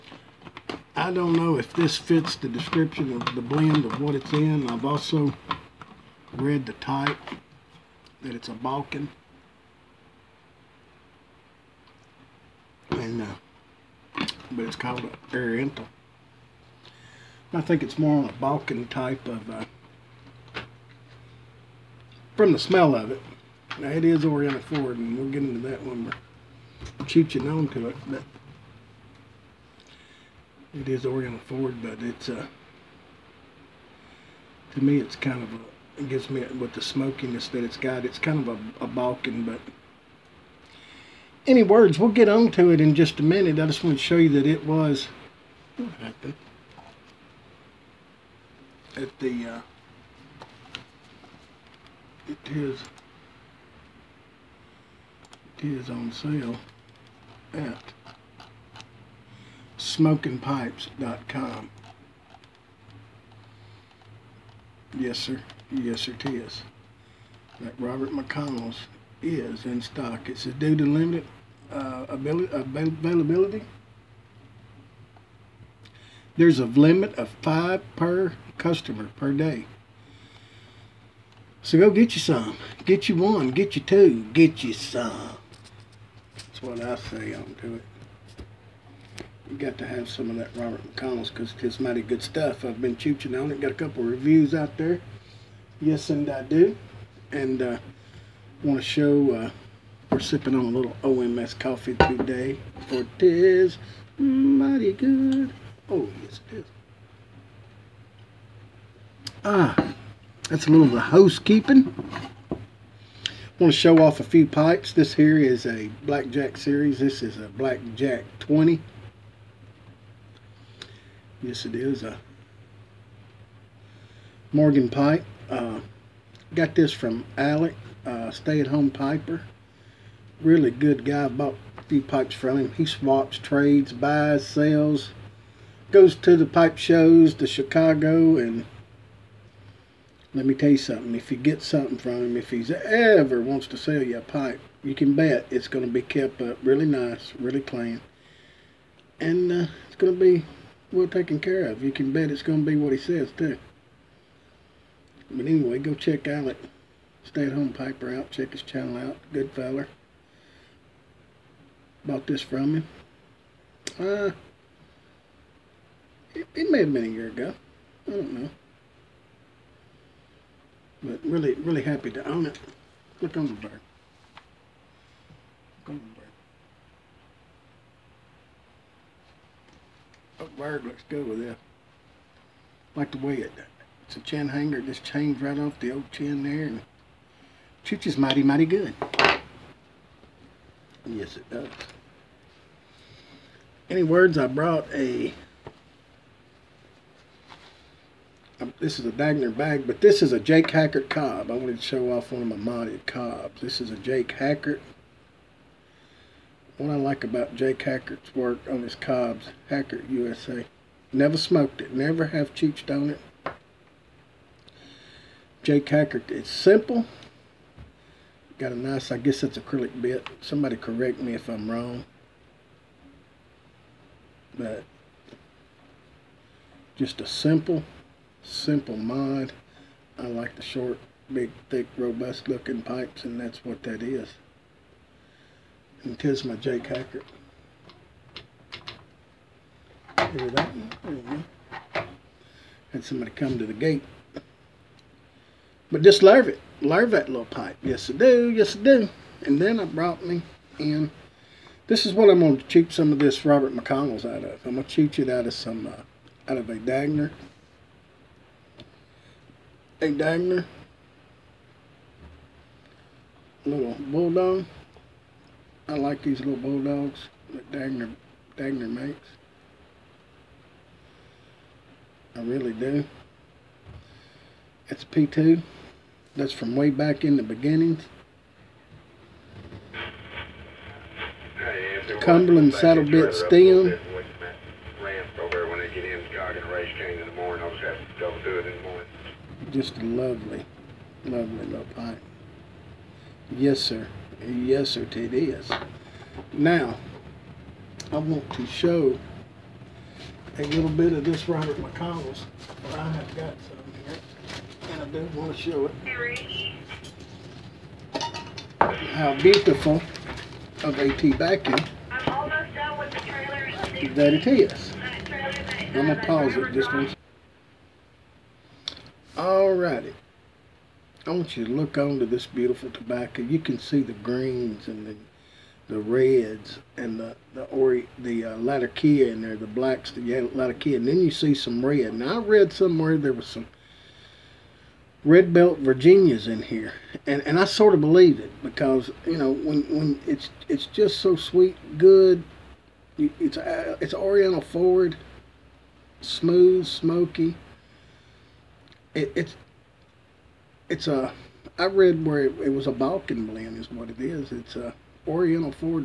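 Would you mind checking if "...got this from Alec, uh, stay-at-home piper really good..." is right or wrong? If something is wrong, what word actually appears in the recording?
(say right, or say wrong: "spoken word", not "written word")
right.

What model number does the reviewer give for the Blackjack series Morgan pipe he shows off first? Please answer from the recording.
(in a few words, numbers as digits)
20.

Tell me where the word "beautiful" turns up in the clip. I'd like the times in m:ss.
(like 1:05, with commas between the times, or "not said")
5:09, 5:22.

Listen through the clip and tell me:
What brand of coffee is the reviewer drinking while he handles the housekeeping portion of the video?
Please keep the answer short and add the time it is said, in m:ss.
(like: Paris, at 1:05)
OMS, at 1:41.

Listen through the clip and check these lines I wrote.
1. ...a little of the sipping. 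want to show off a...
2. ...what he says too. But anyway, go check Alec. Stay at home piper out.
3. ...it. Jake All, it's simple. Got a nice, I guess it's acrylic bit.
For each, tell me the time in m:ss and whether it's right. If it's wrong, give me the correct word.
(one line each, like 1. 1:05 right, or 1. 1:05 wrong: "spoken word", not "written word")
1. 1:50 wrong: "housekeeping", not "sipping"
2. 2:32 right
3. 3:33 wrong: "Hackert", not "All".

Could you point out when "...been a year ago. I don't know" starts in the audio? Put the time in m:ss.
2:46.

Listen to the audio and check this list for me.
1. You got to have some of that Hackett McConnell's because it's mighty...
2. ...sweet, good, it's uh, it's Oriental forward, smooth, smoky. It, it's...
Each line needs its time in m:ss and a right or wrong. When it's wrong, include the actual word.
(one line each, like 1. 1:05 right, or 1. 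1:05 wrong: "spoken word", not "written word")
1. 1:29 wrong: "Robert", not "Hackett"
2. 5:41 right.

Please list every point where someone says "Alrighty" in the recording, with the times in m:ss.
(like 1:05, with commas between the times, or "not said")
5:19.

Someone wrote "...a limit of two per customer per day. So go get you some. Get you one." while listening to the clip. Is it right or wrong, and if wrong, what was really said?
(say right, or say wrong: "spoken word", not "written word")
wrong: "five", not "two".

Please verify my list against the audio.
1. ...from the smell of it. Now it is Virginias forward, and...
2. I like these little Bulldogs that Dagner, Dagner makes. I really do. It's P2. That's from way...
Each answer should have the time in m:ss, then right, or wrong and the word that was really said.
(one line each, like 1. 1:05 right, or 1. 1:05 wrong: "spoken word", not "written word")
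1. 0:22 wrong: "Oriental", not "Virginias"
2. 4:25 right.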